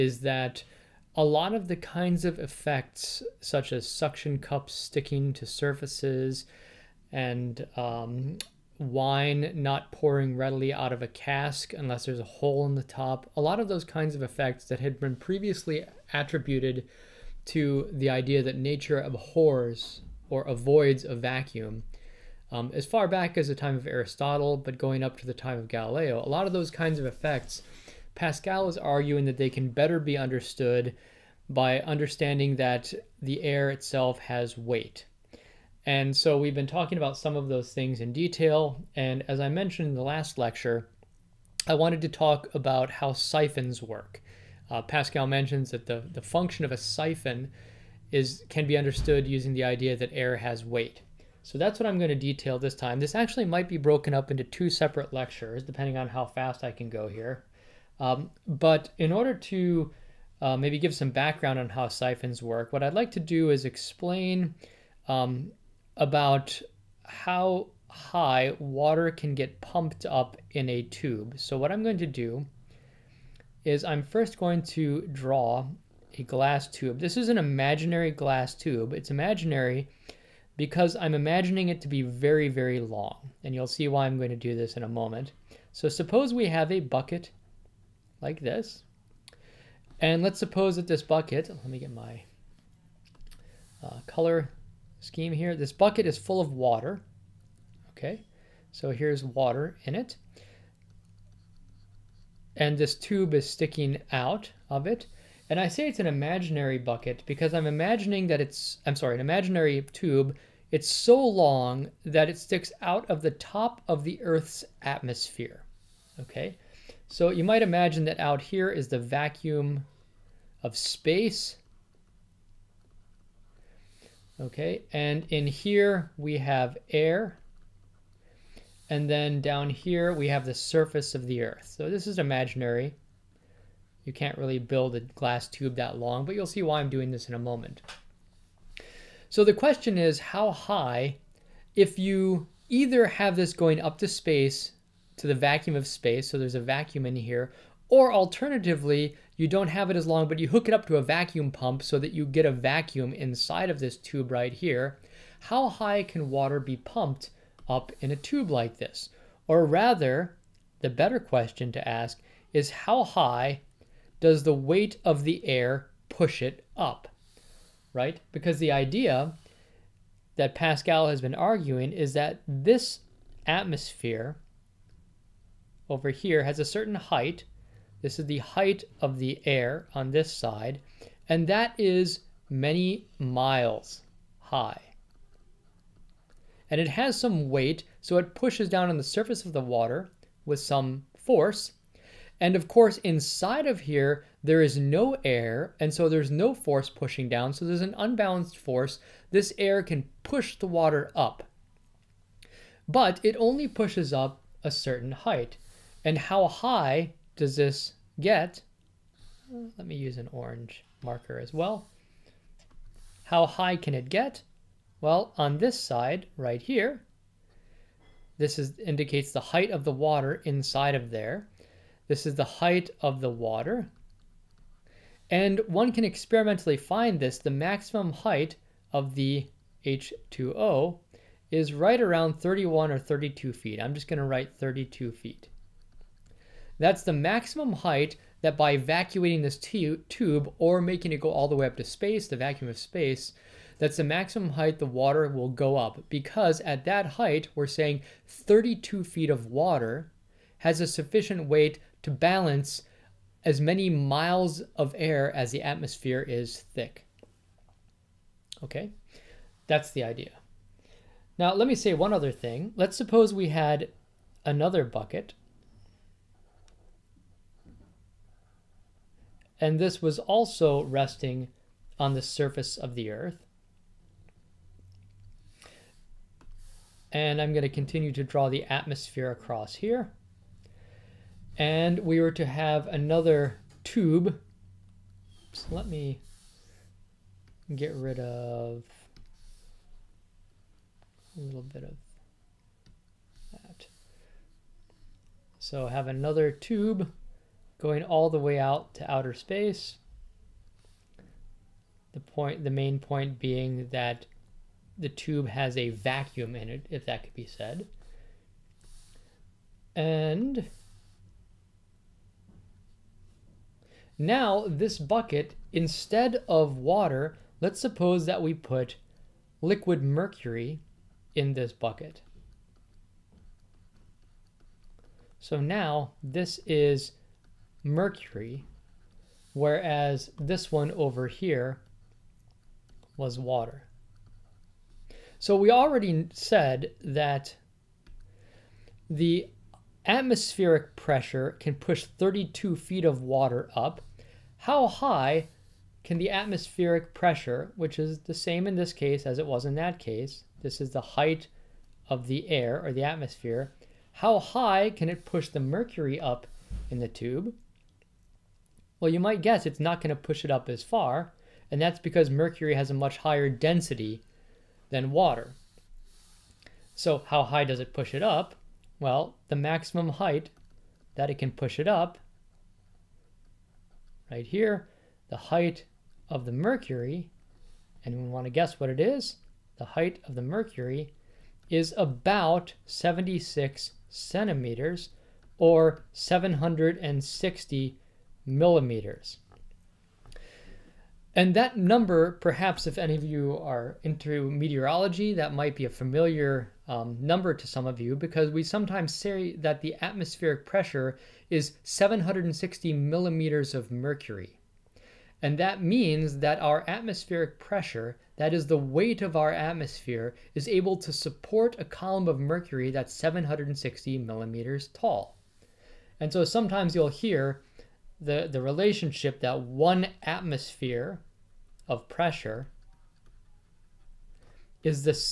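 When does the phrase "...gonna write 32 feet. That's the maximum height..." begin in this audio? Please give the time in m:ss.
3:54.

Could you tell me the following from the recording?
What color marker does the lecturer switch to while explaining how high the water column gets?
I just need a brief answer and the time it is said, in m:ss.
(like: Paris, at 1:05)
Orange, at 3:30.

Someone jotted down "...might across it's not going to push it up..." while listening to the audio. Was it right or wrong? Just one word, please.
wrong.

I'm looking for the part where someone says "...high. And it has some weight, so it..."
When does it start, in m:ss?
3:04.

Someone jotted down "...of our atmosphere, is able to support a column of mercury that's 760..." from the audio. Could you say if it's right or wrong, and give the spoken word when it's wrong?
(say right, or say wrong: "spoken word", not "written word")
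right.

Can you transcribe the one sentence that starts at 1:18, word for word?
It's imaginary because I'm imagining it to be very, very long.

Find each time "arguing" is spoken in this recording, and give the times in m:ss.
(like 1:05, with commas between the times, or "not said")
0:28, 2:51.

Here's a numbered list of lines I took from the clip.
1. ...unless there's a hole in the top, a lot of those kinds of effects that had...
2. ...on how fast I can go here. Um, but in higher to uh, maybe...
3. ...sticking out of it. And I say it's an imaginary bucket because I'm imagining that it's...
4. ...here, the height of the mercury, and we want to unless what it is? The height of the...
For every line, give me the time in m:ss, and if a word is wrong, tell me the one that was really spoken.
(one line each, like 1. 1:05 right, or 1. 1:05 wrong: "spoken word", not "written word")
1. 0:11 right
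2. 0:55 wrong: "order", not "higher"
3. 1:43 right
4. 6:14 wrong: "guess", not "unless".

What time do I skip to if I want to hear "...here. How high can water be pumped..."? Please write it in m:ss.
2:34.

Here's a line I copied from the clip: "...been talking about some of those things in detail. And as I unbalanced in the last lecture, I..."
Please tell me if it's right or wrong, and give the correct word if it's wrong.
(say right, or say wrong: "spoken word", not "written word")
wrong: "mentioned", not "unbalanced".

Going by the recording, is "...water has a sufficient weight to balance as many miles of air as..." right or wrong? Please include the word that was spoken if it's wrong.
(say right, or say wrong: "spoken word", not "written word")
right.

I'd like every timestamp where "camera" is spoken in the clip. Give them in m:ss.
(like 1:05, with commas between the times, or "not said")
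not said.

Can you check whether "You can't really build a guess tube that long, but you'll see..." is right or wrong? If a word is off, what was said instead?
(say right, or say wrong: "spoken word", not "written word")
wrong: "glass", not "guess".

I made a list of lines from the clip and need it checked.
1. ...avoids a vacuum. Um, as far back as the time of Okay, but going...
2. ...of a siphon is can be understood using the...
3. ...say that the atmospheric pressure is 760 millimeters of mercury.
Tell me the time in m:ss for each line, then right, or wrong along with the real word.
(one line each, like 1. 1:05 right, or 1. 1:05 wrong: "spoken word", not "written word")
1. 0:20 wrong: "Aristotle", not "Okay"
2. 0:46 right
3. 6:39 right.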